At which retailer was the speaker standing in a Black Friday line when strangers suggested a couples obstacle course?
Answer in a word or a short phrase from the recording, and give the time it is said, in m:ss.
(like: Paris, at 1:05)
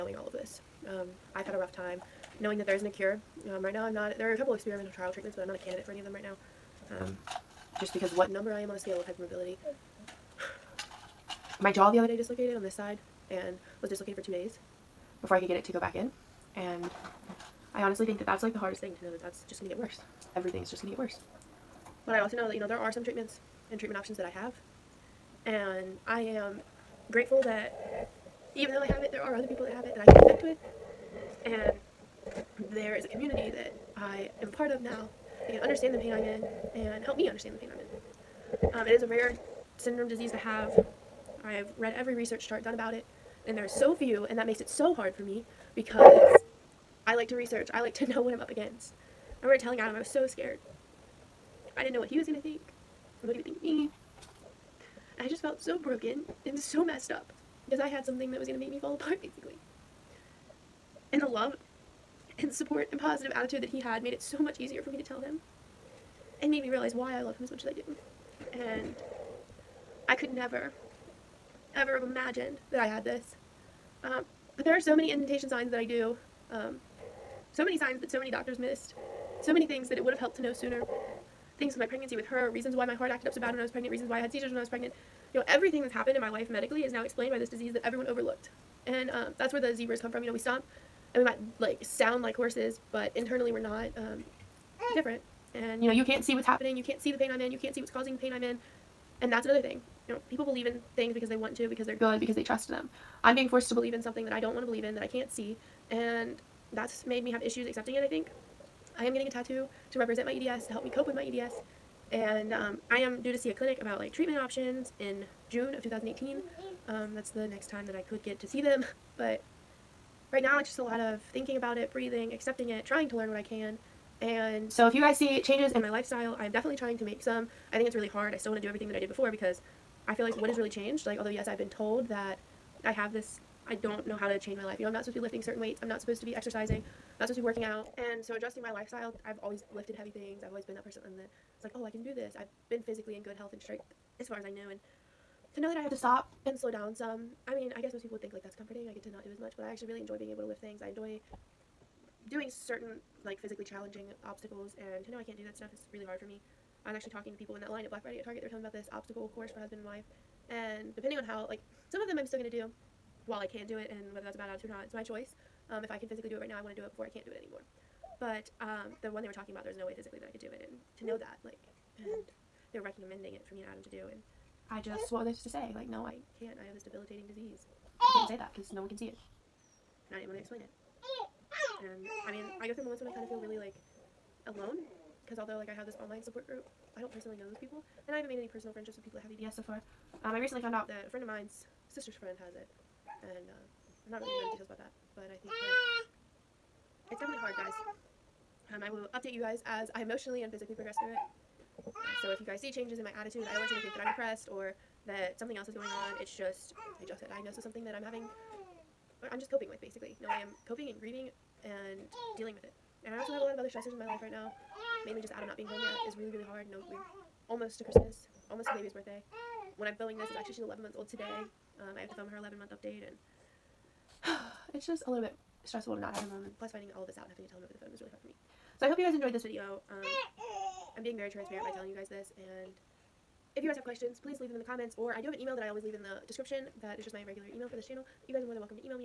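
Target, at 2:38.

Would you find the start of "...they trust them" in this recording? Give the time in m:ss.
1:42.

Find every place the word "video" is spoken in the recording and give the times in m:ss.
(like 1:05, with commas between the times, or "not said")
3:49.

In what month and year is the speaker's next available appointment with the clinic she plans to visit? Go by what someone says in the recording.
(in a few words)
June 2018.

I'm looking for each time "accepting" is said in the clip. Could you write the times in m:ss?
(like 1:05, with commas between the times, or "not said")
1:47, 2:02.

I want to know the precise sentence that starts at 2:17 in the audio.
And so adjusting my lifestyle, I've always lifted heavy things.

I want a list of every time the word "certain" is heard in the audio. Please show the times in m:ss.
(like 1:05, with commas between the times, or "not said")
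2:15, 2:32.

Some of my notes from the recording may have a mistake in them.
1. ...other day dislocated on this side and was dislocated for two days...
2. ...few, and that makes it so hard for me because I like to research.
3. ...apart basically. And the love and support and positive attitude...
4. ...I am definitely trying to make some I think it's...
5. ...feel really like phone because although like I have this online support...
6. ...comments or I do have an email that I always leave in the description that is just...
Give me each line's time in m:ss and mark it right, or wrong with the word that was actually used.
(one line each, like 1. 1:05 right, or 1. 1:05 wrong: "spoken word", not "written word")
1. 0:11 right
2. 0:43 right
3. 0:58 right
4. 2:06 right
5. 3:03 wrong: "alone", not "phone"
6. 3:54 right.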